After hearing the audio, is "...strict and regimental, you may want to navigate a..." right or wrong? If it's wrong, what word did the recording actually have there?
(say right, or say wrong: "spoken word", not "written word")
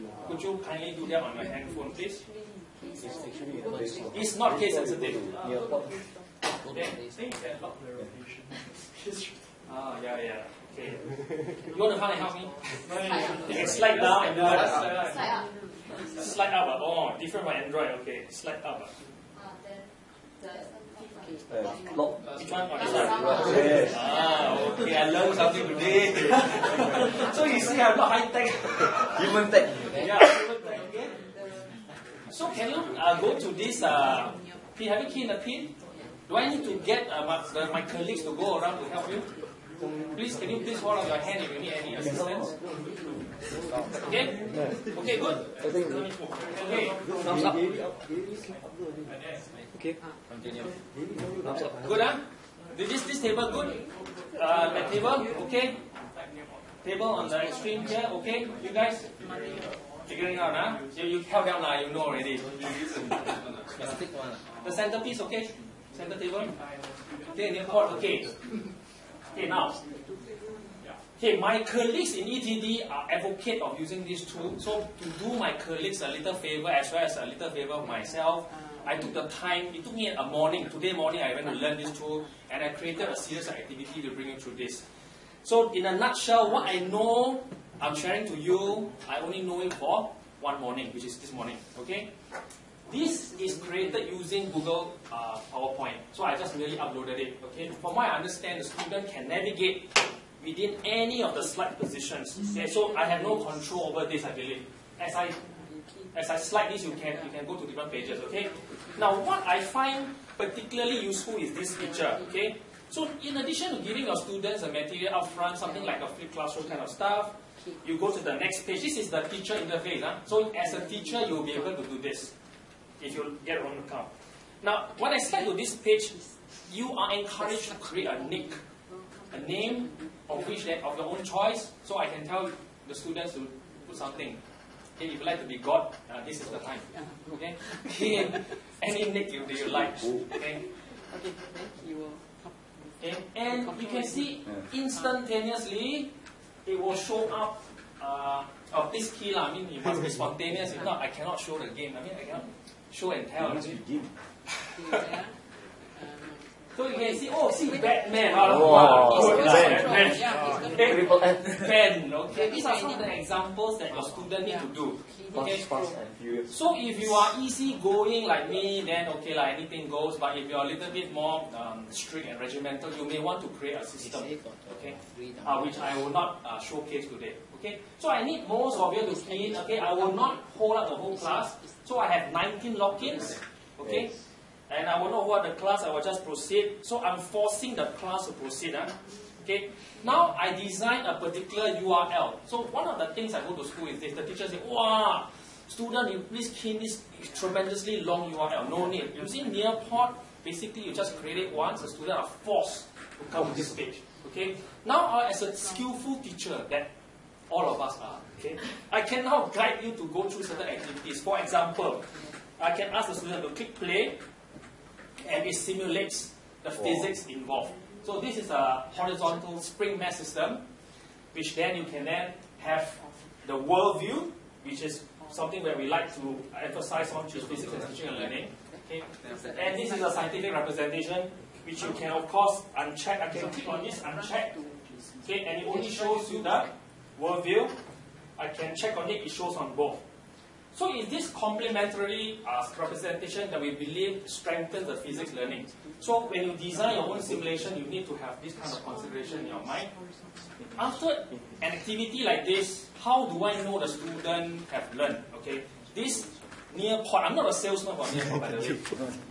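wrong: "create", not "navigate".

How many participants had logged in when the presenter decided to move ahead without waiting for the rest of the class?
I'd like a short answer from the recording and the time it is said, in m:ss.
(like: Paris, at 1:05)
19, at 3:02.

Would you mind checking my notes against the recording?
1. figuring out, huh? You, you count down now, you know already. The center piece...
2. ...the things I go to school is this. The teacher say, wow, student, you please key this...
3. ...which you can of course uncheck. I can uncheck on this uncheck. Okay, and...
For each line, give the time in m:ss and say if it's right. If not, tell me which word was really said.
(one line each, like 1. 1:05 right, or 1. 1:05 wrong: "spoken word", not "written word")
1. 1:00 right
2. 3:12 right
3. 3:51 wrong: "click", not "uncheck".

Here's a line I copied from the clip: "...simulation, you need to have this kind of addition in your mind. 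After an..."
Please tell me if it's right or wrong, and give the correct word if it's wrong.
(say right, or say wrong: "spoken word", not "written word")
wrong: "consideration", not "addition".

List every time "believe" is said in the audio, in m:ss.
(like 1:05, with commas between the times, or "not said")
1:44, 4:03.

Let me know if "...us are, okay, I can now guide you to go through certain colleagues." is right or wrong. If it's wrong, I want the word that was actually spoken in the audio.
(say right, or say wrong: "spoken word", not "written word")
wrong: "activities", not "colleagues".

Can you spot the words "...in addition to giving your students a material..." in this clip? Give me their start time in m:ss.
1:53.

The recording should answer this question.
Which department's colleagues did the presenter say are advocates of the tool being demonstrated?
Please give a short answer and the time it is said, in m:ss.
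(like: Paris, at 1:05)
ETD, at 1:12.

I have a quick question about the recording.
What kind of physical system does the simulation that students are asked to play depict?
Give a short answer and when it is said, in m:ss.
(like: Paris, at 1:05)
horizontal spring mass system, at 3:38.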